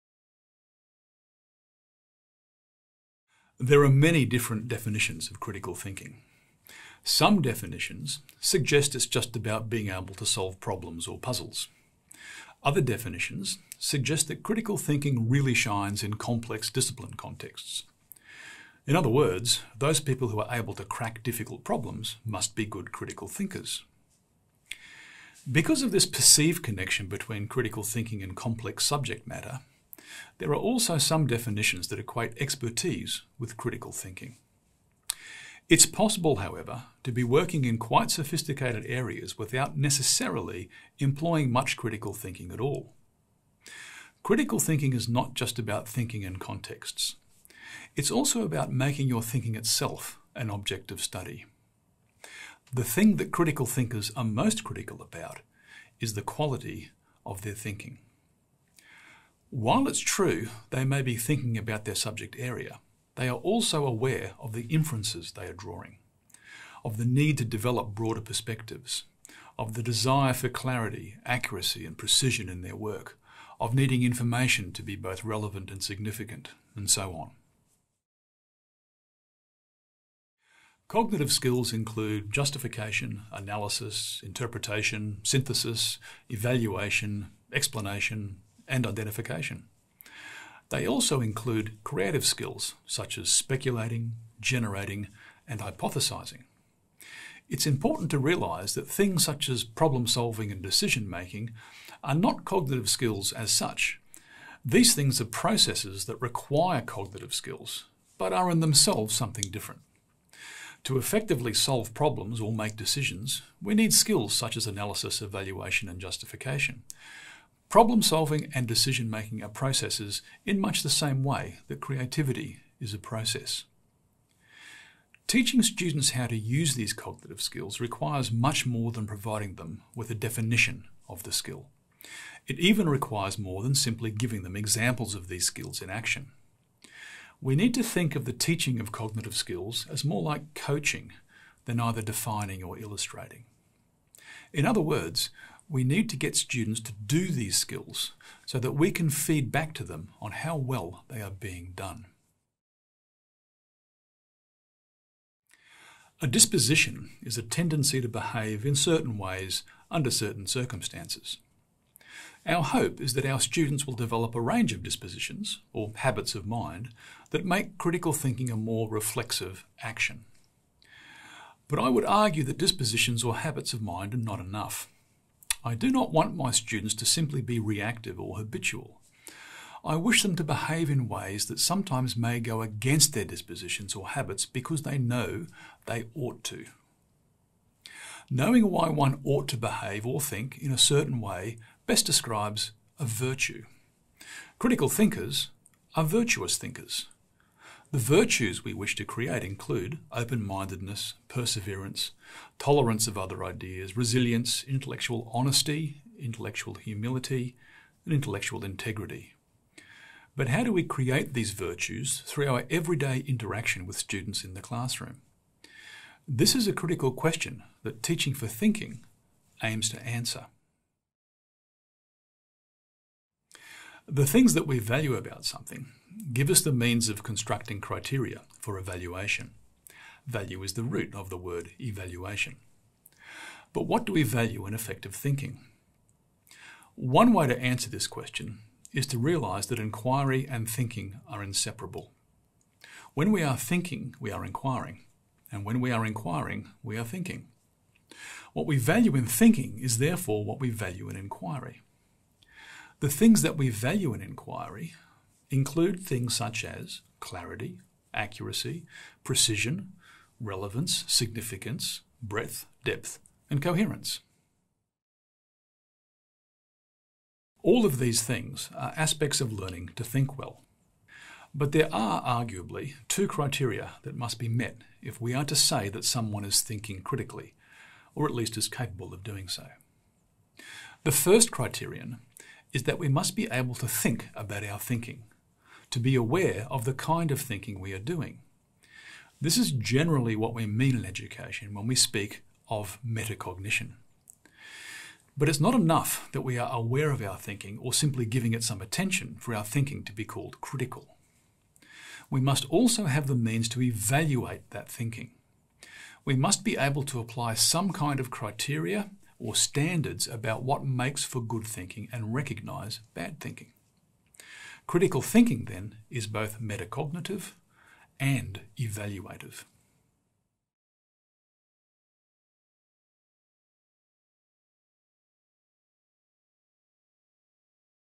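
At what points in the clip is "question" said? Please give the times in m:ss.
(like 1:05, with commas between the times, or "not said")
3:37, 3:58.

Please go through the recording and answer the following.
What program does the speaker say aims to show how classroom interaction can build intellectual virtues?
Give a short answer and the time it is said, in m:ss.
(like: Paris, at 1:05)
Teaching for Thinking, at 3:38.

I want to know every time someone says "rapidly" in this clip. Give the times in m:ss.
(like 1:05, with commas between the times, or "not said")
not said.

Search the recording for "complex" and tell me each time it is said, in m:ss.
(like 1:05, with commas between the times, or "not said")
0:16, 0:28.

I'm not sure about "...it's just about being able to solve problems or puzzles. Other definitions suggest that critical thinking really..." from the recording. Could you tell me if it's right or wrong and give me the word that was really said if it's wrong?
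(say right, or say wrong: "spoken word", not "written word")
right.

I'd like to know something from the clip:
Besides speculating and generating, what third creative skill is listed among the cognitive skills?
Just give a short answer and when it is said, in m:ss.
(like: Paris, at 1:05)
hypothesizing, at 1:35.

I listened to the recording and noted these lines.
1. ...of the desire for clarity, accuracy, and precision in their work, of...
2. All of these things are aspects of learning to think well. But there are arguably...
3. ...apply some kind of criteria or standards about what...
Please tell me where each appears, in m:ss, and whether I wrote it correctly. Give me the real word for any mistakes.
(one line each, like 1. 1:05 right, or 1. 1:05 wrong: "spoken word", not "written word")
1. 1:09 right
2. 4:27 right
3. 5:07 right.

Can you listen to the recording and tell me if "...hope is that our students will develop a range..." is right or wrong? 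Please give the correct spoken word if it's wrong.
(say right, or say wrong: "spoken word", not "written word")
right.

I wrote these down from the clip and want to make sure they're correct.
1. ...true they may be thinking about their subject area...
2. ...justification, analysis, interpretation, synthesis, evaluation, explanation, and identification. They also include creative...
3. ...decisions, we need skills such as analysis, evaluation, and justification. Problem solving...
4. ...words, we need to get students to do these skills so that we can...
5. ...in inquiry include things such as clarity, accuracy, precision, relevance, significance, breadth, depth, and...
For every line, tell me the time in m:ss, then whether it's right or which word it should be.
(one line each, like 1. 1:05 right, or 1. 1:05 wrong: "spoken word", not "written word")
1. 0:59 right
2. 1:22 right
3. 1:52 right
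4. 2:24 right
5. 4:14 right.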